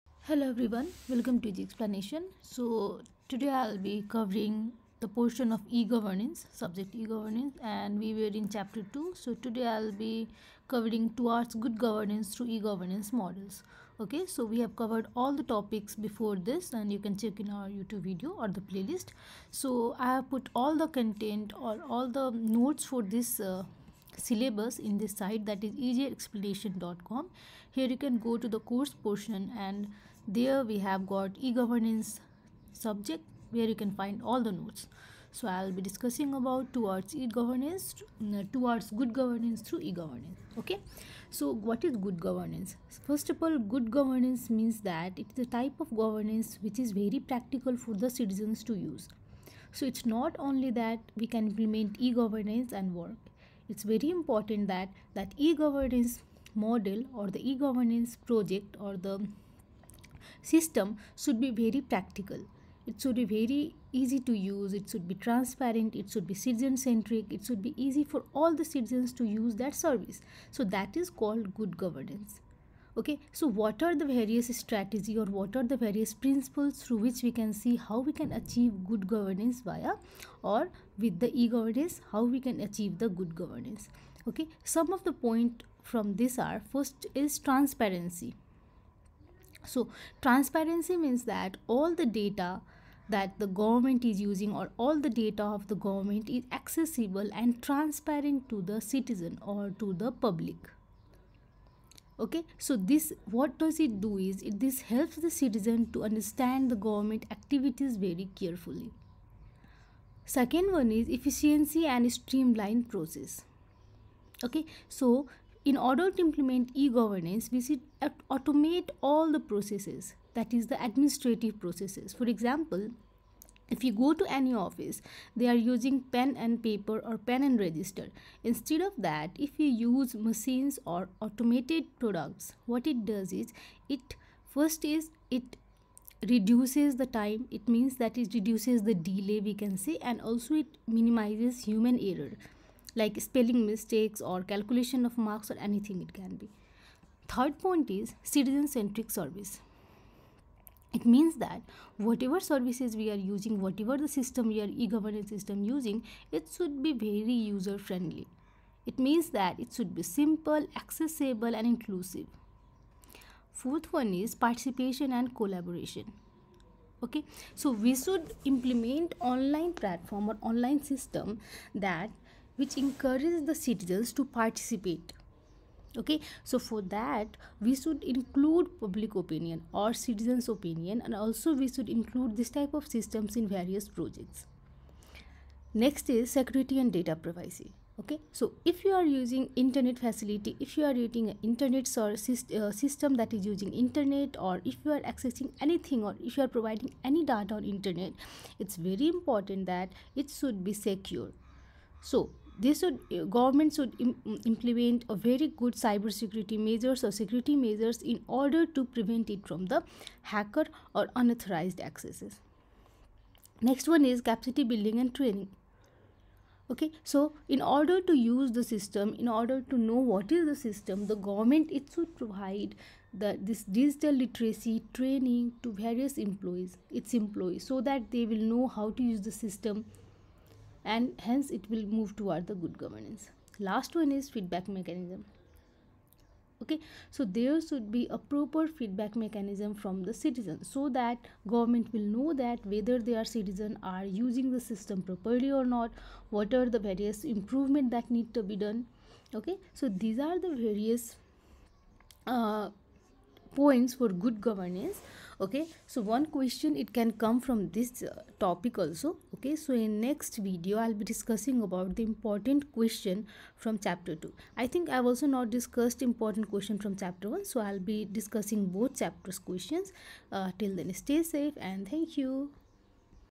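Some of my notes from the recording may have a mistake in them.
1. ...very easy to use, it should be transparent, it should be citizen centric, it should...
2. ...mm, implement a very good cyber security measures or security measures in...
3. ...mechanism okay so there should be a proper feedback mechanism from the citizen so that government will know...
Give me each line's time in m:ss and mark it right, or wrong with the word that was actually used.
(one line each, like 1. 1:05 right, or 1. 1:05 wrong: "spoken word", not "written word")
1. 1:03 right
2. 3:24 right
3. 3:54 right.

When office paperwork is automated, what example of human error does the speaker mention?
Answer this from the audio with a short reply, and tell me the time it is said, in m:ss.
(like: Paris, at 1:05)
Spelling mistakes, at 2:23.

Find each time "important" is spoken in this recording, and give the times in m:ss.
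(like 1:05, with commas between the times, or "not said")
0:54, 3:19, 4:22, 4:26.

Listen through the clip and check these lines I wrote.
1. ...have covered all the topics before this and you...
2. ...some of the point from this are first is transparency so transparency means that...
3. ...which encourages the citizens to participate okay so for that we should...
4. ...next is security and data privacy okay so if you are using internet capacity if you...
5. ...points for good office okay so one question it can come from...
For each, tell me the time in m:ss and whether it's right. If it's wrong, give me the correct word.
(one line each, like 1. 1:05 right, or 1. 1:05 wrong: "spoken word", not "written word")
1. 0:14 right
2. 1:24 right
3. 2:52 right
4. 3:05 wrong: "facility", not "capacity"
5. 4:13 wrong: "governance", not "office".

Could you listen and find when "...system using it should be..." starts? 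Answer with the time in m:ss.
2:35.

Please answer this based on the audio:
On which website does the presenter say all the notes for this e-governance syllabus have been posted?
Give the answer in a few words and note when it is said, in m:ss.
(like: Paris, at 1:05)
easyexplanation.com, at 0:25.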